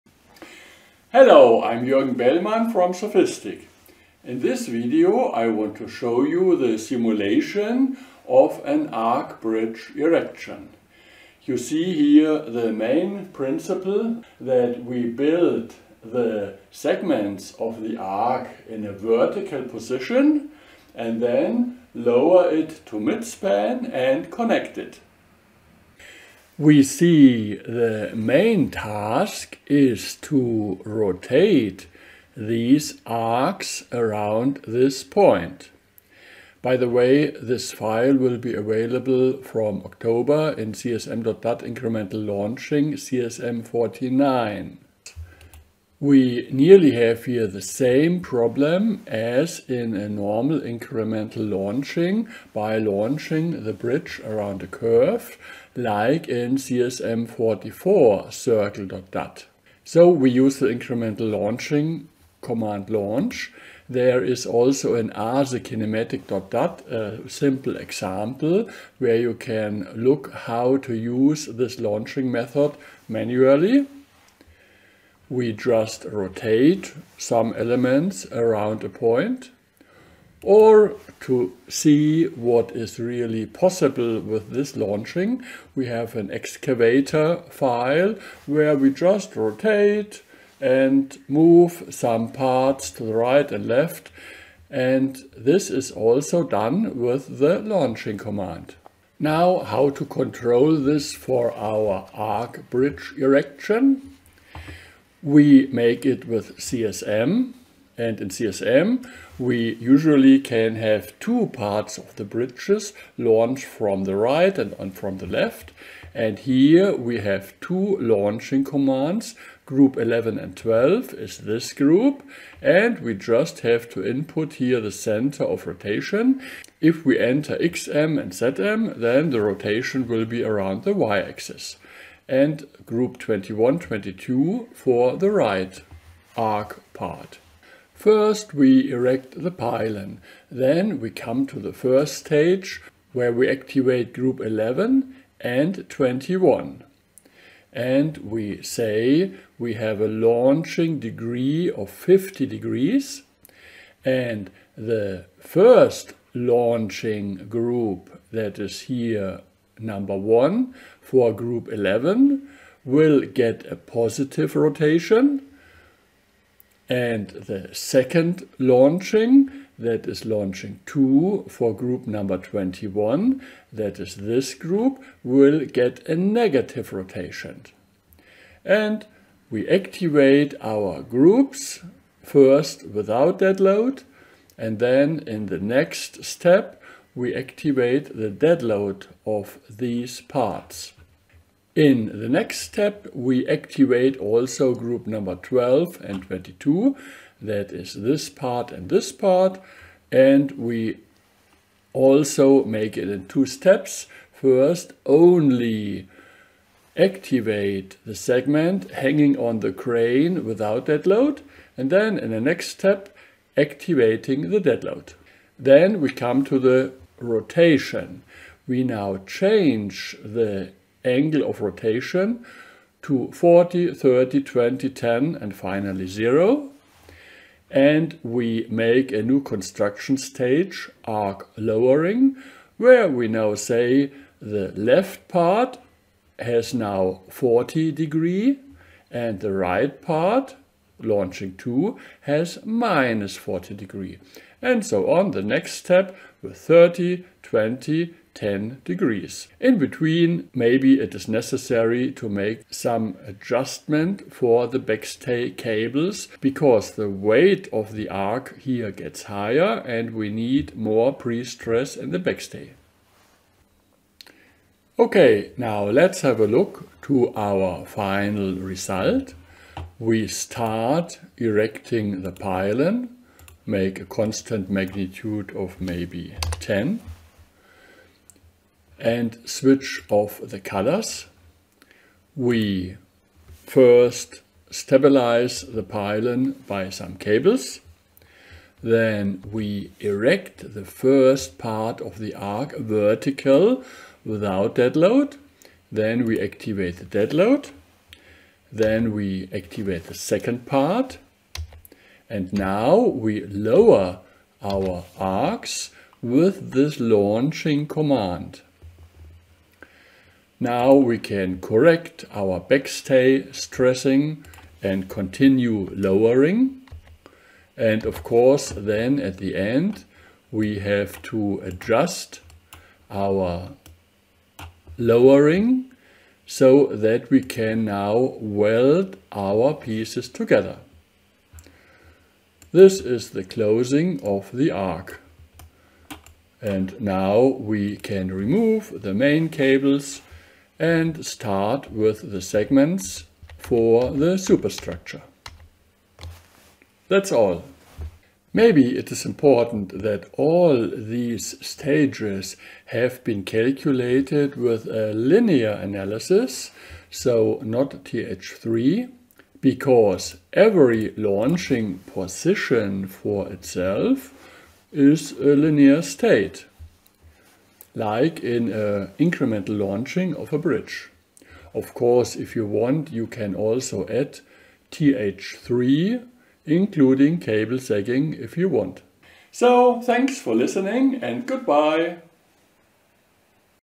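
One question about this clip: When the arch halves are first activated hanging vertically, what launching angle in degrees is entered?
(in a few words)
50 degrees.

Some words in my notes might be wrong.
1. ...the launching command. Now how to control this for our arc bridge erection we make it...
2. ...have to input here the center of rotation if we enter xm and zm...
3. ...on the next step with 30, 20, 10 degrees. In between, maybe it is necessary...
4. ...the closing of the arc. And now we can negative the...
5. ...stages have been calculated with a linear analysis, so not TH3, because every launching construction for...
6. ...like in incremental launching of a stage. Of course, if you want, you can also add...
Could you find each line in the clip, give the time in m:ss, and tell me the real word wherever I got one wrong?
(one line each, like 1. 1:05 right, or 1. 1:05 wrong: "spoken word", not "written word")
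1. 1:37 right
2. 2:03 right
3. 4:05 right
4. 5:33 wrong: "remove", not "negative"
5. 5:51 wrong: "position", not "construction"
6. 6:07 wrong: "bridge", not "stage".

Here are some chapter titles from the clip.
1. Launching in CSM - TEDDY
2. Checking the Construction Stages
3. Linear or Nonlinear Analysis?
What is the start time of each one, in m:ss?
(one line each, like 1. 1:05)
1. 1:39
2. 4:23
3. 5:48.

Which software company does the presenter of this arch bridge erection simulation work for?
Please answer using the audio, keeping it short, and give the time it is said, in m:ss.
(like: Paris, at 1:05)
SOFiSTiK, at 0:02.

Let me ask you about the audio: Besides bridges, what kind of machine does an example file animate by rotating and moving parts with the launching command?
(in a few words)
an excavator.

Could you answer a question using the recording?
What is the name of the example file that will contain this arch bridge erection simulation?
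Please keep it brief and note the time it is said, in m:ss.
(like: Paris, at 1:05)
CSM49, at 0:42.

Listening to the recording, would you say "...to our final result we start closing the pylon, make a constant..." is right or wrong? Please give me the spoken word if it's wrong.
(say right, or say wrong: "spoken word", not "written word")
wrong: "erecting", not "closing".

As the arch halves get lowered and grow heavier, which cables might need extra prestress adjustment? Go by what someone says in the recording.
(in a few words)
backstay cables.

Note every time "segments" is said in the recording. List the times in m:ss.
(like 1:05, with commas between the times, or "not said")
0:16, 3:28, 5:42.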